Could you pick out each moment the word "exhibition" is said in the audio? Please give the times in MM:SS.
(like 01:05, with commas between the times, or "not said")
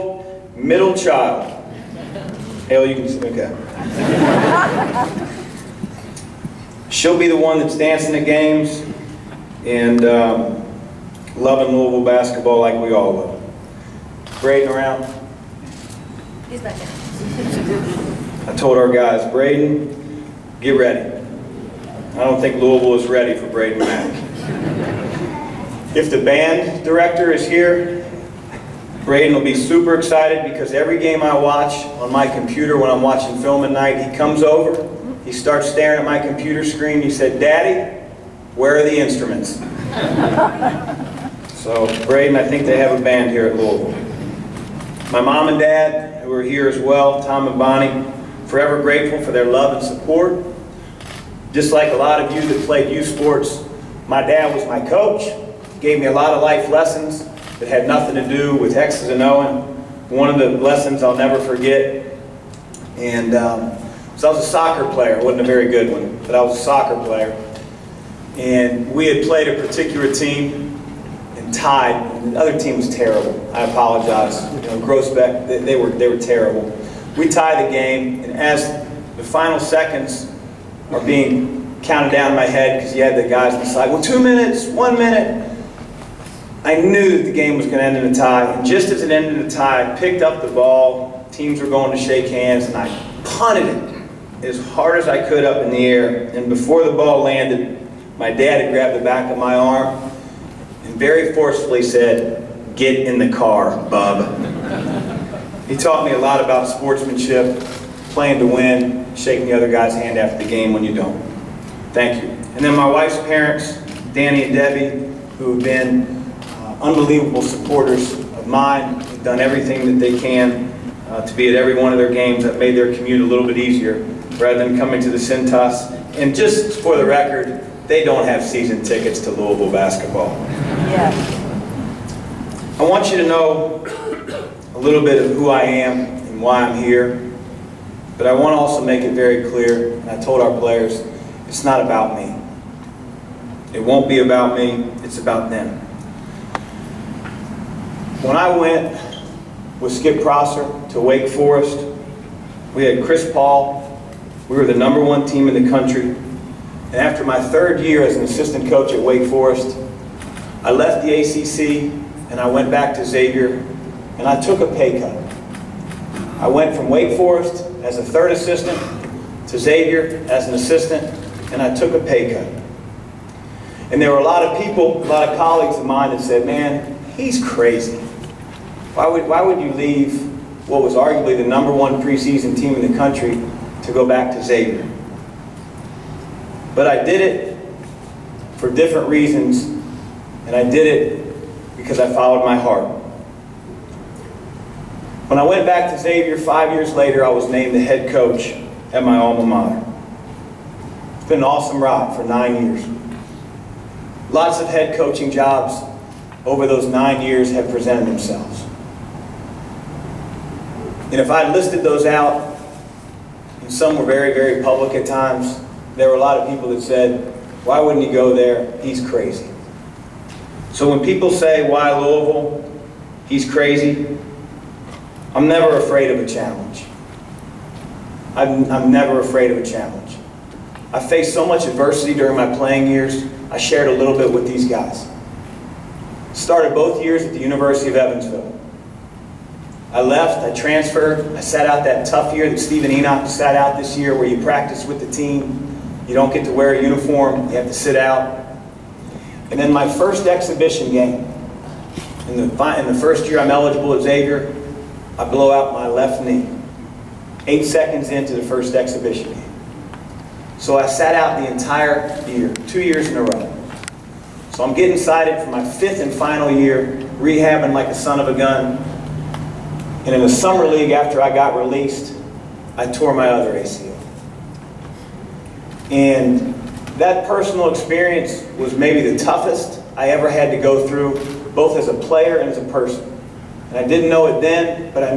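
04:10, 04:18.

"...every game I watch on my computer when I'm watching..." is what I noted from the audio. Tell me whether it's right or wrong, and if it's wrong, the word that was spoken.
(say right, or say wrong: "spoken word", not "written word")
right.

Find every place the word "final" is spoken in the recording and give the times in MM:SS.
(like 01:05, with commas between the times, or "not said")
01:19, 04:26.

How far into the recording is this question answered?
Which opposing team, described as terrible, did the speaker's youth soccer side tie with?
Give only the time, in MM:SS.
01:14.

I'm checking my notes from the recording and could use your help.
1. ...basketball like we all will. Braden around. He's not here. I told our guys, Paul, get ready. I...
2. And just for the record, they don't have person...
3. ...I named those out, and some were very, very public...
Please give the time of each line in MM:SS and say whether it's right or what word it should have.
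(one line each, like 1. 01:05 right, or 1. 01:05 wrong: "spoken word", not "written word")
1. 00:12 wrong: "Braden", not "Paul"
2. 02:06 wrong: "season", not "person"
3. 03:31 wrong: "listed", not "named".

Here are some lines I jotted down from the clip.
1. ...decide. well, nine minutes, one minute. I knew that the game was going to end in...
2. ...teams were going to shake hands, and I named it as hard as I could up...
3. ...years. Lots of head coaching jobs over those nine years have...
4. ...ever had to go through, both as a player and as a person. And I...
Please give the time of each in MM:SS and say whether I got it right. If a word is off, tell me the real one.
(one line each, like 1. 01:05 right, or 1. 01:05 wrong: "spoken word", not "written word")
1. 01:23 wrong: "two", not "nine"
2. 01:31 wrong: "punted", not "named"
3. 03:22 right
4. 04:40 right.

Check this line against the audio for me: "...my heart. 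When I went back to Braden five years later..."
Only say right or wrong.
wrong.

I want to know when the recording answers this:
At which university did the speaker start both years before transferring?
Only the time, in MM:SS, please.
03:57.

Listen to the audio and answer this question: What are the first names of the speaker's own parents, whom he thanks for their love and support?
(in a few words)
Tom and Bonnie.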